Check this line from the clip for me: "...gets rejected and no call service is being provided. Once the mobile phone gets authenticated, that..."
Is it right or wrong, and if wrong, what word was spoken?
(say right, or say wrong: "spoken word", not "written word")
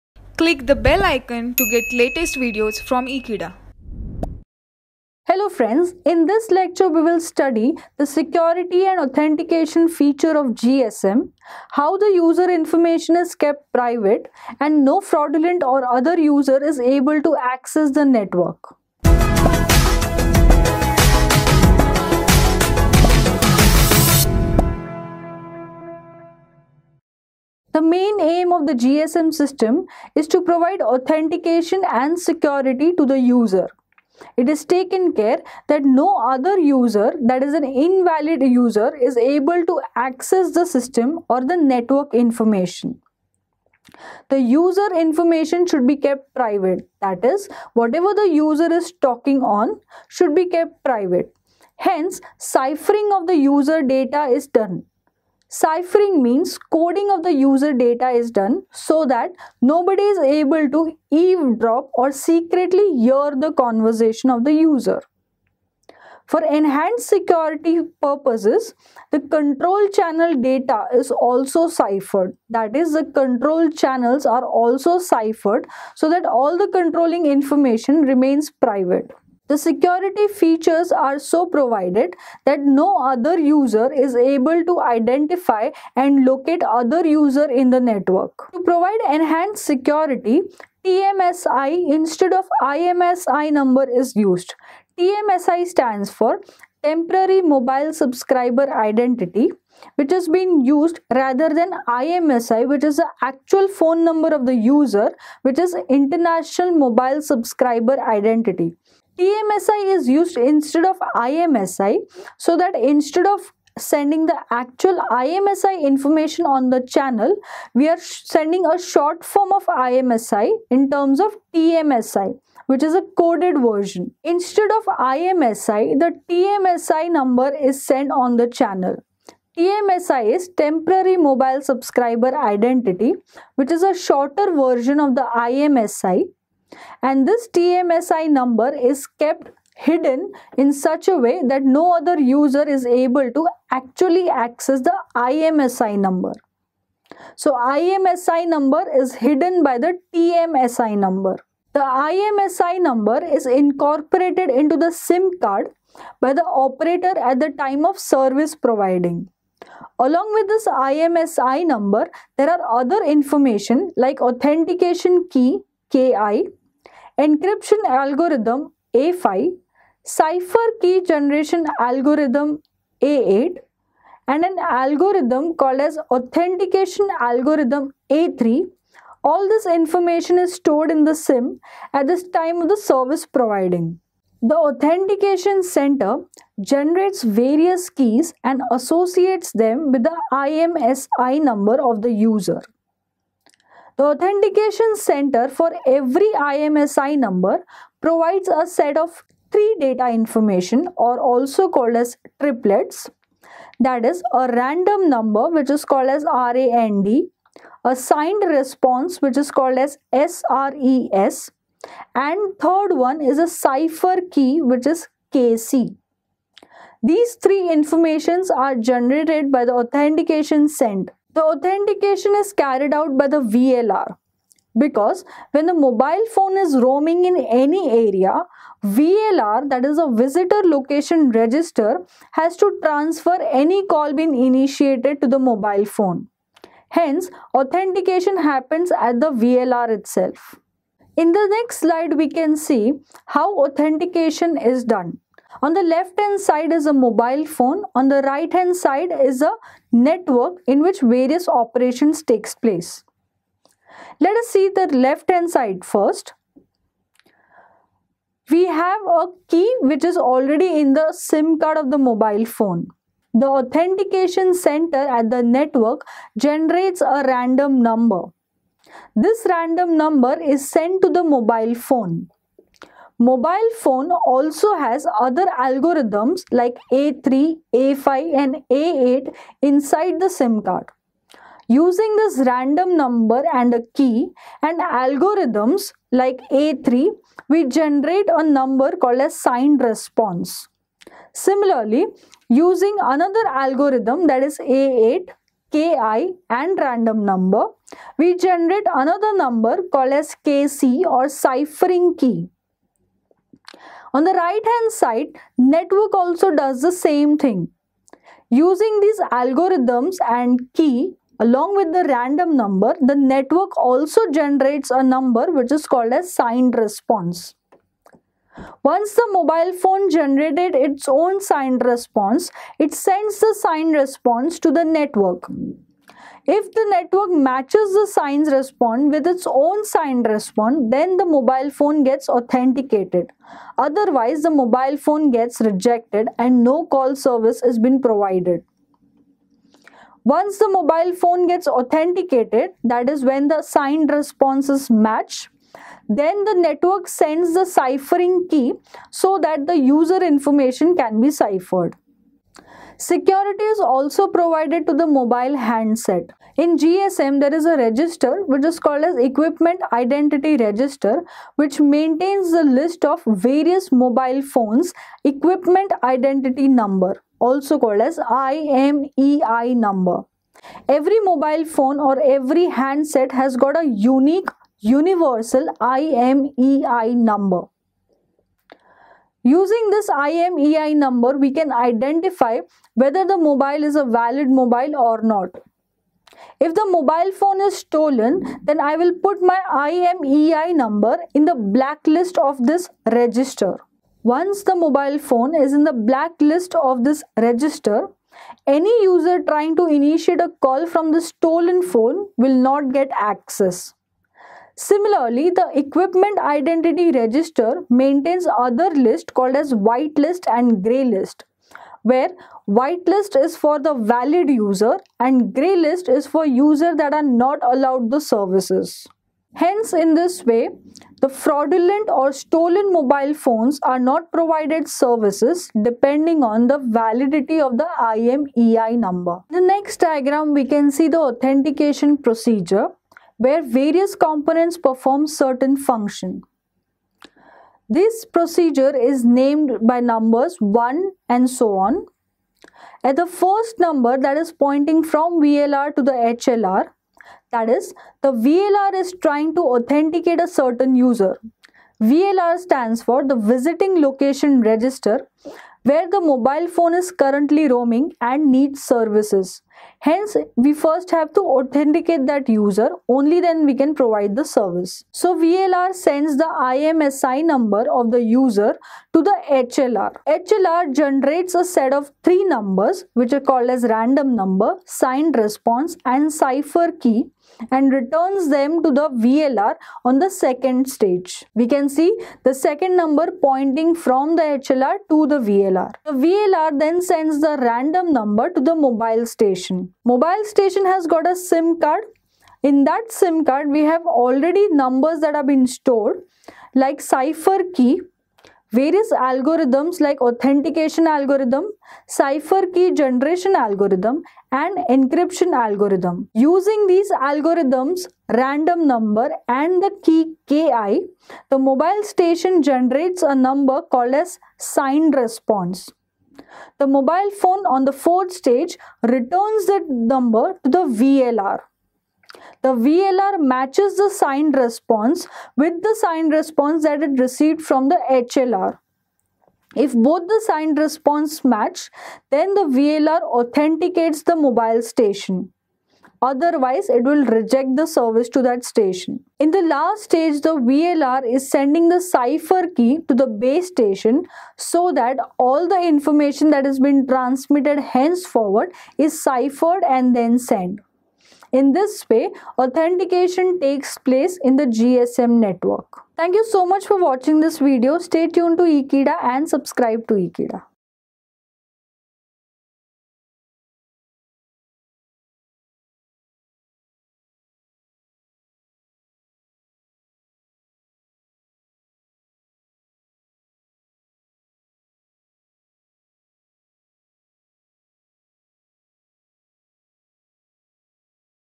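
right.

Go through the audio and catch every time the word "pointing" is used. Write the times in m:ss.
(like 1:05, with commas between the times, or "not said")
7:24, 8:03.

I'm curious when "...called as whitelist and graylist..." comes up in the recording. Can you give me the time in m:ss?
6:49.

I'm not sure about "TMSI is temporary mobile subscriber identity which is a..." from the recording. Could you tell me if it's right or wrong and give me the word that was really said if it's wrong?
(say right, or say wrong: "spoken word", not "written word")
right.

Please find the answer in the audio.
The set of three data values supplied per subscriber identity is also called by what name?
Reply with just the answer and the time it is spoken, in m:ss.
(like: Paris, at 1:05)
triplets, at 3:22.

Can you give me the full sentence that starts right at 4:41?
Using this random number and a key and algorithms like A3, we generate a number called as signed response.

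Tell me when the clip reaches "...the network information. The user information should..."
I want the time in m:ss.
0:41.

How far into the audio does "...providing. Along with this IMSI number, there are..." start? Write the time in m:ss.
2:38.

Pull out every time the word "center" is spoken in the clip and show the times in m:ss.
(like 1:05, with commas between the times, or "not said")
3:05, 3:14, 3:40, 4:24.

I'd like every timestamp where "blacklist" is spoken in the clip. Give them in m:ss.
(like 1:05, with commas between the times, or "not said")
6:31, 6:35.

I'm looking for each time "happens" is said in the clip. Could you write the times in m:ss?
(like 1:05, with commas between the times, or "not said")
3:58.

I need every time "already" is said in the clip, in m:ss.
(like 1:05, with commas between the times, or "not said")
4:20, 8:14.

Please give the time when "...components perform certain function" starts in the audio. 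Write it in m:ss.
7:14.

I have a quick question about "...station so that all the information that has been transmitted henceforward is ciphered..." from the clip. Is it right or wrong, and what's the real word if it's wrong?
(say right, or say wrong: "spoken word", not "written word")
right.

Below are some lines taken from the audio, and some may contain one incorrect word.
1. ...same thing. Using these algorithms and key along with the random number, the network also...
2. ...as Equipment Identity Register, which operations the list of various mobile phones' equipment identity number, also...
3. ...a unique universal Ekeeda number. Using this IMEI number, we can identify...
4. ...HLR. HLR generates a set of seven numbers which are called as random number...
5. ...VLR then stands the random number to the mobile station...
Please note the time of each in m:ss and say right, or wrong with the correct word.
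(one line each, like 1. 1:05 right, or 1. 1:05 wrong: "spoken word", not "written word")
1. 5:06 right
2. 5:59 wrong: "maintains", not "operations"
3. 6:13 wrong: "IMEI", not "Ekeeda"
4. 7:49 wrong: "three", not "seven"
5. 8:06 wrong: "sends", not "stands".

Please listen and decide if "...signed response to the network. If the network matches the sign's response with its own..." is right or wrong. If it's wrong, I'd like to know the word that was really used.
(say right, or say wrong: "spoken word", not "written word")
right.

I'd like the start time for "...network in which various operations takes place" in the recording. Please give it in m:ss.
4:09.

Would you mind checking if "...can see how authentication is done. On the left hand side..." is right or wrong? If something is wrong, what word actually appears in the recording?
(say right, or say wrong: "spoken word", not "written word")
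right.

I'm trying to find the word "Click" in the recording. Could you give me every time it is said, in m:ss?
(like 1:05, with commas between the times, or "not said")
0:00.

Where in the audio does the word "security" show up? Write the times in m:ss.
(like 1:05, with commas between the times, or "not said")
0:08, 0:32, 1:07, 1:19, 1:29, 5:53.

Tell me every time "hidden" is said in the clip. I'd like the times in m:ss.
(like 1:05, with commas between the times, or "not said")
2:19, 2:29.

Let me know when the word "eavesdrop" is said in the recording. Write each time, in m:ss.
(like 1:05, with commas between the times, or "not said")
1:01.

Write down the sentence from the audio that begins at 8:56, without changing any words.
Otherwise, it will reject the service to that station.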